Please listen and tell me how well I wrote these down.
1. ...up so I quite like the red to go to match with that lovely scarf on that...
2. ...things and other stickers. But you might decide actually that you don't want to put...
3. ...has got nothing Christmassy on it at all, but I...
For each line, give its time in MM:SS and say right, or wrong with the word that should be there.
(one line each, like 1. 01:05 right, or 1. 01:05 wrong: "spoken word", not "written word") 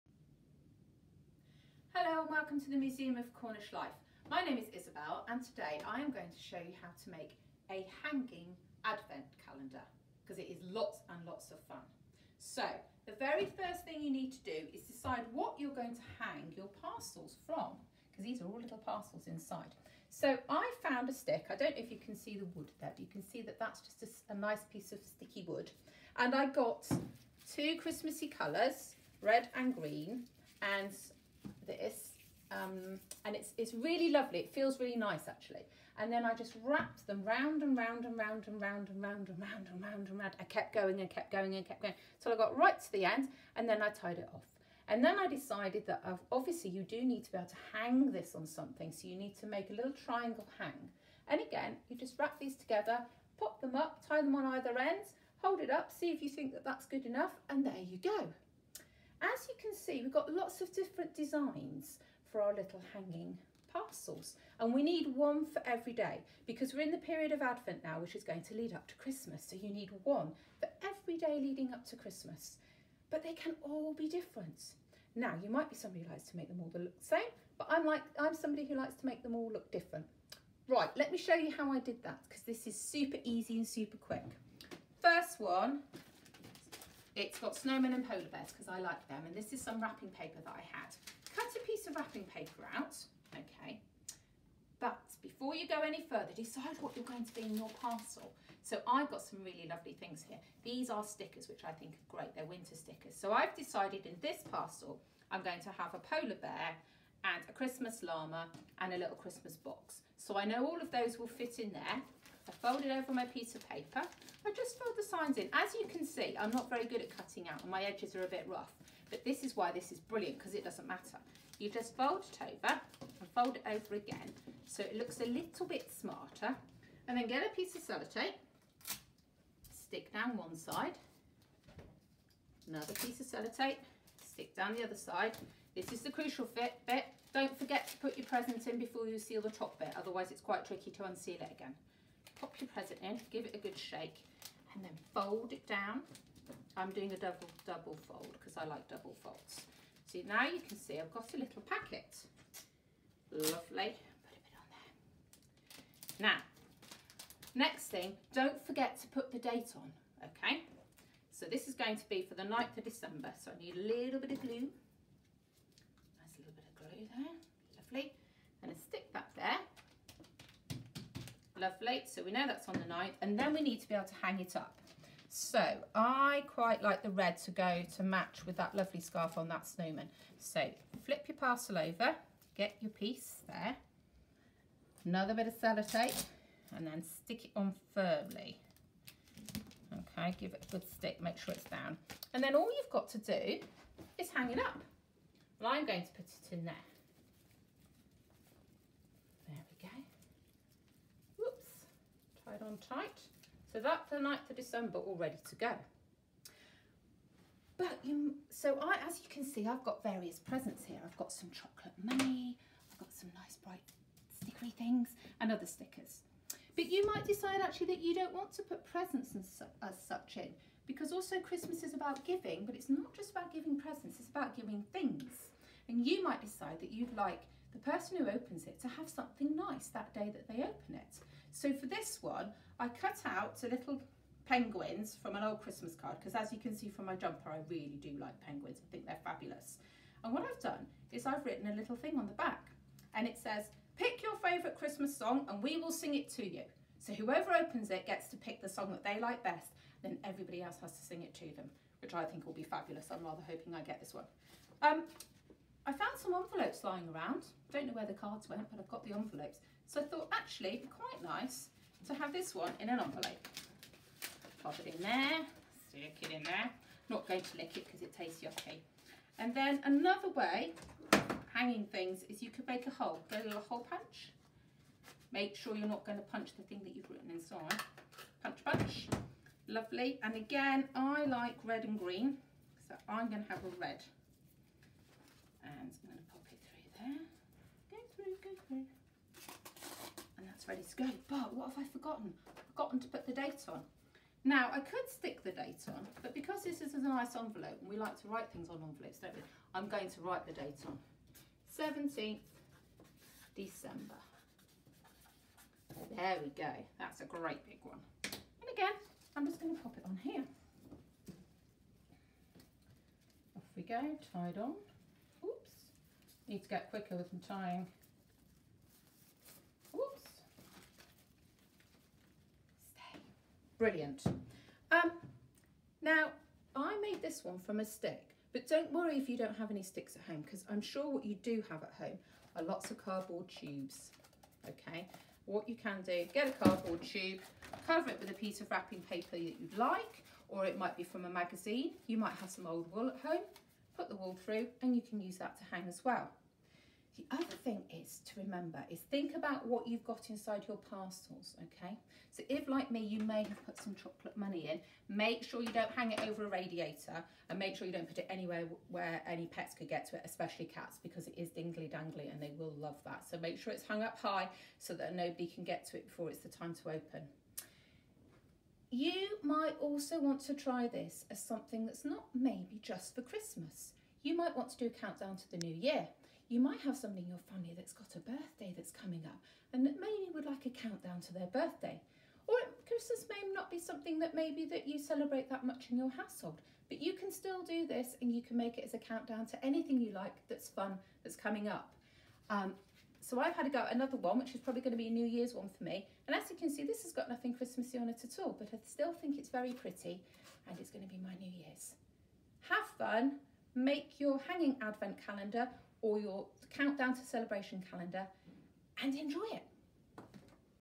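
1. 02:54 right
2. 03:34 right
3. 06:37 right.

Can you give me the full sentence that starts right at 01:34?
But before you go any further, decide what you're going to be in your parcel.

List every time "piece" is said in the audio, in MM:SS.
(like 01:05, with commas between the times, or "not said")
00:24, 01:31, 01:53, 02:07, 02:12, 03:02, 05:38.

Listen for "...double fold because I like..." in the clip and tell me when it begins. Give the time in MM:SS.
02:27.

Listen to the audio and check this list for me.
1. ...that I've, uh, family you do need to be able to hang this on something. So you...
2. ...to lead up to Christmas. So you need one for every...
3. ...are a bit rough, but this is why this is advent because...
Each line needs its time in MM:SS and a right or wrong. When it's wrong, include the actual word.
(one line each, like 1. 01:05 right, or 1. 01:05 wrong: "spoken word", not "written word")
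1. 00:45 wrong: "obviously", not "family"
2. 01:08 right
3. 01:58 wrong: "brilliant", not "advent".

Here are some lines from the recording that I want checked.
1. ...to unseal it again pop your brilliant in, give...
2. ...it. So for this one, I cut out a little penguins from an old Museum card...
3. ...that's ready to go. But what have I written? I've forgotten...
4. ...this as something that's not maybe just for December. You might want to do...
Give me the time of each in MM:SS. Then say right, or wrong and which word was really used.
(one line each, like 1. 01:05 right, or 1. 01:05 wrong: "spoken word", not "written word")
1. 02:20 wrong: "present", not "brilliant"
2. 03:50 wrong: "Christmas", not "Museum"
3. 04:50 wrong: "forgotten", not "written"
4. 06:10 wrong: "Christmas", not "December".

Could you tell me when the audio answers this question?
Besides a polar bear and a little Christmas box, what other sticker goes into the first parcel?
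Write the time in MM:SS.
01:47.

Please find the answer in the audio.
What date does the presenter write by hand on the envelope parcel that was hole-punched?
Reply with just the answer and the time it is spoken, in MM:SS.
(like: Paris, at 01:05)
17th December, at 05:01.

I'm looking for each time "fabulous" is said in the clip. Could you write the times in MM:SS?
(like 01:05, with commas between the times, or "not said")
03:59, 04:12.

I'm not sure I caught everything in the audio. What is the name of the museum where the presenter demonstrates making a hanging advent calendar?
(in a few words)
Museum of Cornish Life.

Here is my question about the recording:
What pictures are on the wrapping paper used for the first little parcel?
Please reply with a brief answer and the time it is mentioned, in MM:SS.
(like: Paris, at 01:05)
snowmen and polar bears, at 01:27.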